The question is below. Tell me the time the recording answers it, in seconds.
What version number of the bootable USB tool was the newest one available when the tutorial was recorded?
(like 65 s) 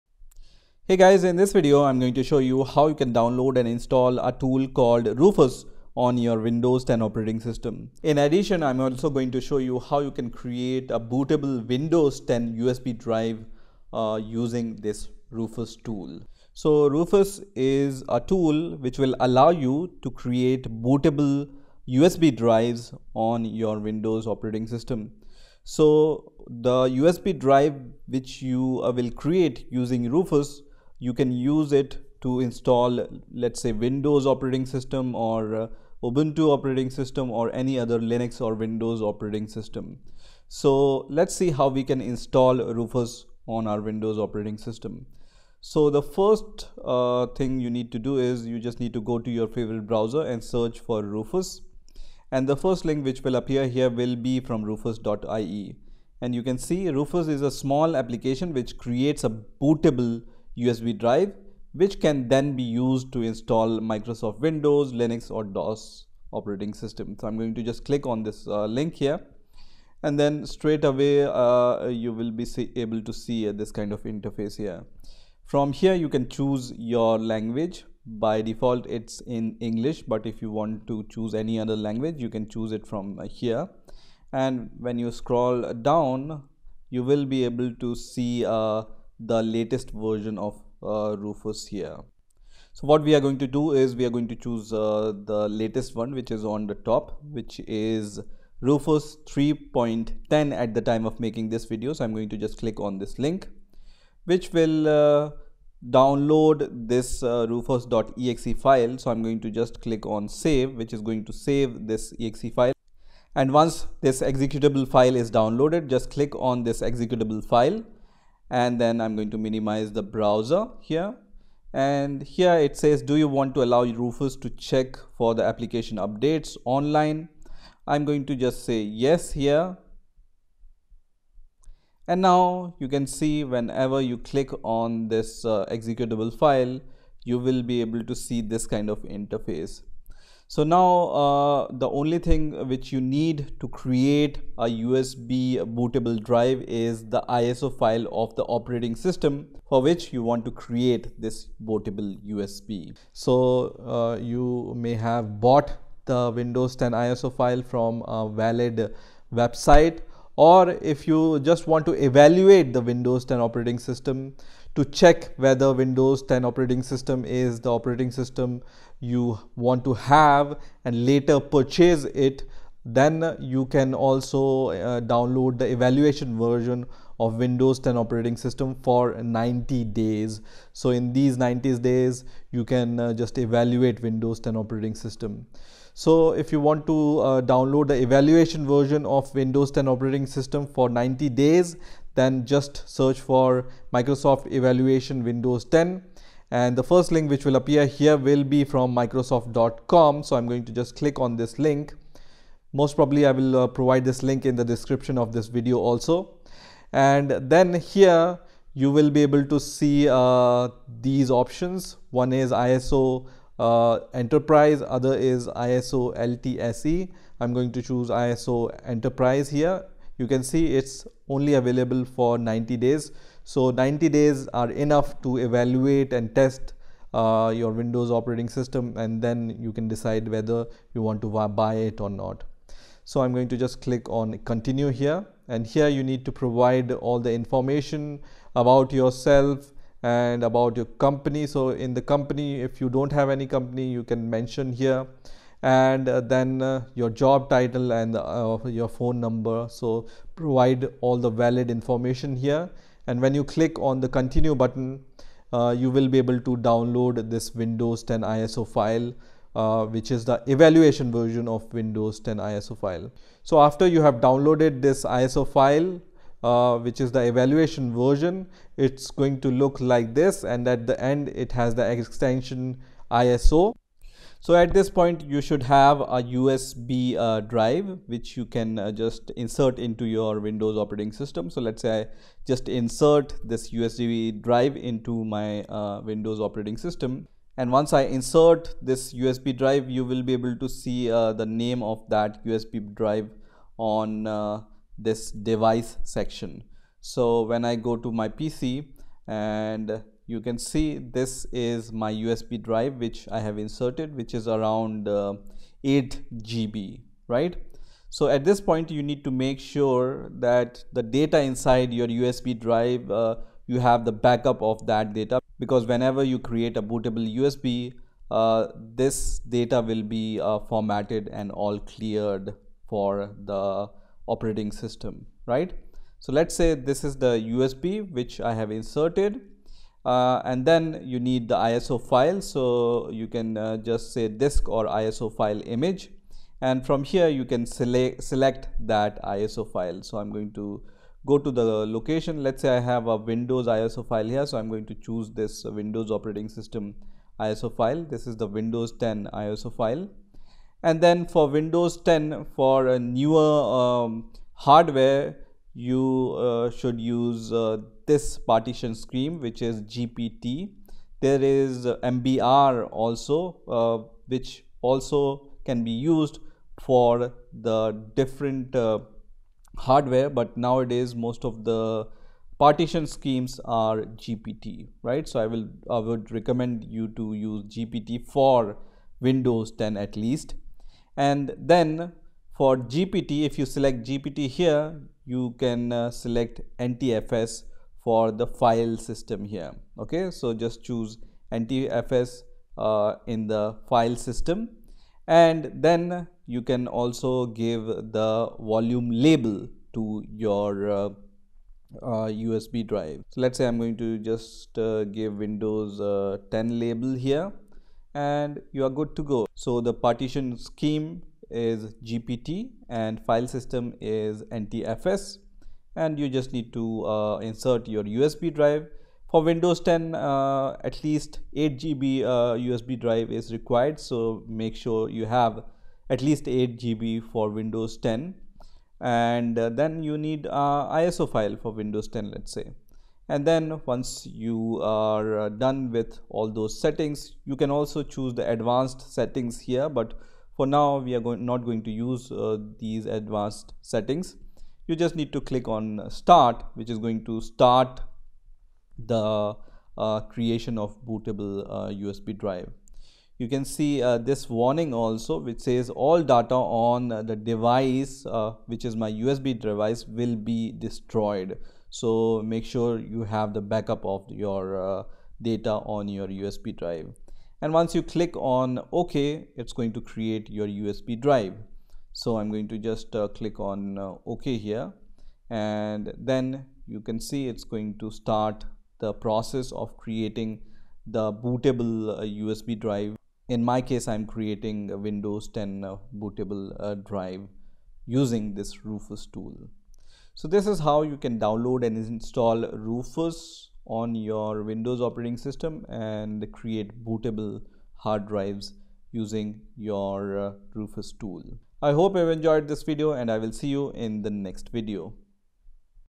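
98 s.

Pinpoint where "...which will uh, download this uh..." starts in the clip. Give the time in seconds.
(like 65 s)
104 s.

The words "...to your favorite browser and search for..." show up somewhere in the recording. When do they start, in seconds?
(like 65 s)
49 s.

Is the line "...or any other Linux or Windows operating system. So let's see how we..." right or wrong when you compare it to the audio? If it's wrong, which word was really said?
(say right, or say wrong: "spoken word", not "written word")
right.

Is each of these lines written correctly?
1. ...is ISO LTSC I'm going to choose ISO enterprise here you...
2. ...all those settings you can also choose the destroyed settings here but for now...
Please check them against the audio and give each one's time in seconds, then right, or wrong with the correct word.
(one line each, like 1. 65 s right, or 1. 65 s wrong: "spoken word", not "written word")
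1. 215 s right
2. 436 s wrong: "advanced", not "destroyed".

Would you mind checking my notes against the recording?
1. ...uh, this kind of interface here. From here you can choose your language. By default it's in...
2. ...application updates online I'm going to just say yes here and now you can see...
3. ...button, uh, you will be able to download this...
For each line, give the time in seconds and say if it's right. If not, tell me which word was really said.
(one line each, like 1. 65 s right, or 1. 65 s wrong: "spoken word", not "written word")
1. 73 s right
2. 125 s right
3. 254 s right.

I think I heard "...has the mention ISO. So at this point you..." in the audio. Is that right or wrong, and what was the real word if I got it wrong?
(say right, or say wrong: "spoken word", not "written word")
wrong: "extension", not "mention".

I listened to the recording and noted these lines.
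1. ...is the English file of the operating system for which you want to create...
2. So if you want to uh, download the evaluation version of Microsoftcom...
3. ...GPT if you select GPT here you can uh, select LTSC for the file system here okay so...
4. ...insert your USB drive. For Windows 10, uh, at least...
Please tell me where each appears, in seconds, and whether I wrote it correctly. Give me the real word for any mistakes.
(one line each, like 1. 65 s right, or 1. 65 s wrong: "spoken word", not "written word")
1. 146 s wrong: "ISO", not "English"
2. 185 s wrong: "Windows", not "Microsoftcom"
3. 382 s wrong: "NTFS", not "LTSC"
4. 417 s right.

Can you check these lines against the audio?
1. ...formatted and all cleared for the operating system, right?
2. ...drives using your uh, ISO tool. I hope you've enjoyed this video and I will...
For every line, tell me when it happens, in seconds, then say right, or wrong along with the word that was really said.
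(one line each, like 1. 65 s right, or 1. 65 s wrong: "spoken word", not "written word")
1. 320 s right
2. 498 s wrong: "Rufus", not "ISO".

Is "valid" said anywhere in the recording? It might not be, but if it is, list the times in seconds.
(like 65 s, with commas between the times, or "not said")
158 s, 251 s.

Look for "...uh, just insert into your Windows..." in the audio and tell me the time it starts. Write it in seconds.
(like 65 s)
278 s.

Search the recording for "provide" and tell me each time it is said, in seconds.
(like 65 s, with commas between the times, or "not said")
203 s, 236 s, 250 s.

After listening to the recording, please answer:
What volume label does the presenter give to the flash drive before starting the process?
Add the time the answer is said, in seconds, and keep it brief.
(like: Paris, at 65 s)
Windows 10, at 405 s.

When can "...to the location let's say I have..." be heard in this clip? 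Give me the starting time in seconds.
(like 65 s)
341 s.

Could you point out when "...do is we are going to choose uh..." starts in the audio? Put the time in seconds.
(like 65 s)
93 s.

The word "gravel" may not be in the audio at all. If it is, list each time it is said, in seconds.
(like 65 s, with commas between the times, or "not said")
not said.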